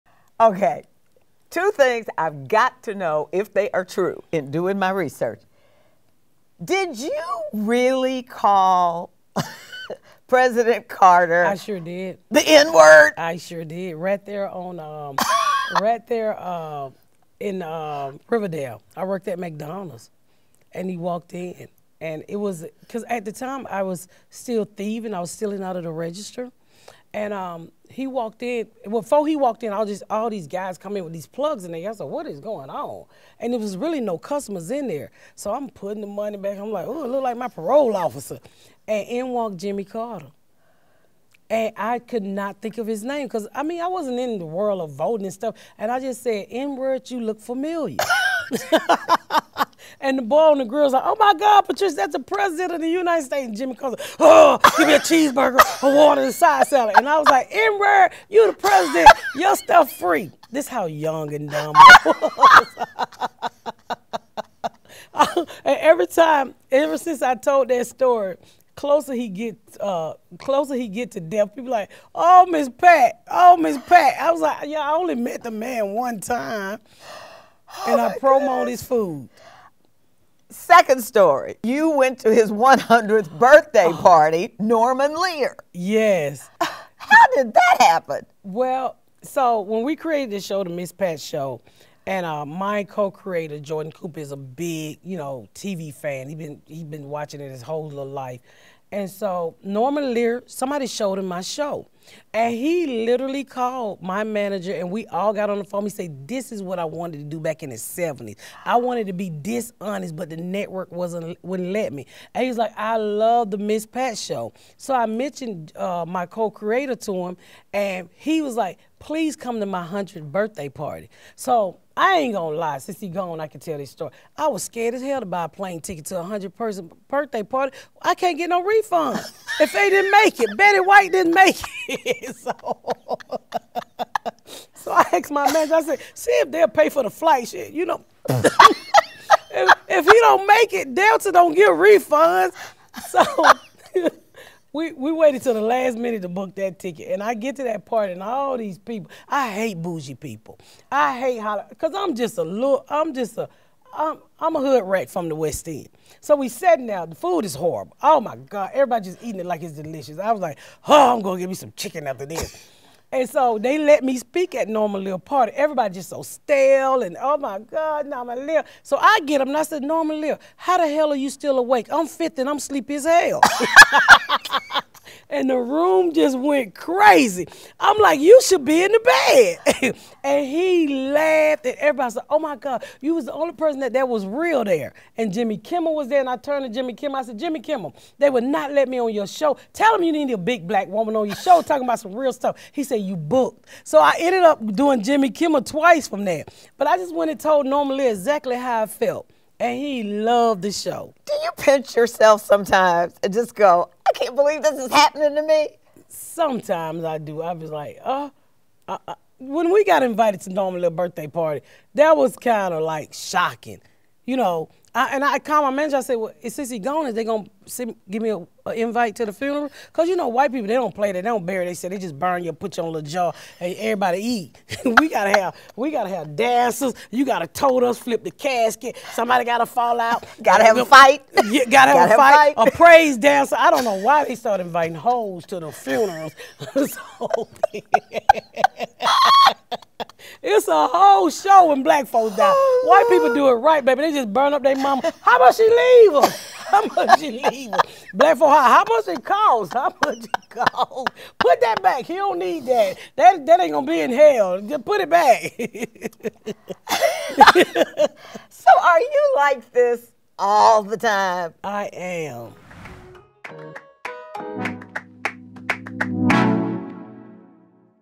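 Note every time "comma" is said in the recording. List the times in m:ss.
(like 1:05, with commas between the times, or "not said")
not said.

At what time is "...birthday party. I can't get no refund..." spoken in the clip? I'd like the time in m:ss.
2:07.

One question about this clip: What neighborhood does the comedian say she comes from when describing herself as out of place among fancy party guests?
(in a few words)
West End.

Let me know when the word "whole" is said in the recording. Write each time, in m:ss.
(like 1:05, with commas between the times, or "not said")
1:37, 4:00.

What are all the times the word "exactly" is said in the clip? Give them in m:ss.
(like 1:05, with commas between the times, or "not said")
3:18.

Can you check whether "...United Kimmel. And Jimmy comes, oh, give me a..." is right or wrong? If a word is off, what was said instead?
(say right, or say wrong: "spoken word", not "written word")
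wrong: "States", not "Kimmel".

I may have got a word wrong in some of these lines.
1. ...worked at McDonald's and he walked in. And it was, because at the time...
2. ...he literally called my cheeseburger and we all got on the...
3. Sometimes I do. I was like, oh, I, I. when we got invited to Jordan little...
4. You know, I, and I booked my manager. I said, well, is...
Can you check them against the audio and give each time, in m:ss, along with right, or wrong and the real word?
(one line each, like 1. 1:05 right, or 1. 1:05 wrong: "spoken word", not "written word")
1. 0:19 right
2. 1:42 wrong: "manager", not "cheeseburger"
3. 3:26 wrong: "Norman", not "Jordan"
4. 3:34 wrong: "called", not "booked".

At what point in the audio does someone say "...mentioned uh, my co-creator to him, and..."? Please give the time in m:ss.
1:55.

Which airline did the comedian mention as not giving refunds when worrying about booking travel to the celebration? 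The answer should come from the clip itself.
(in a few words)
Delta.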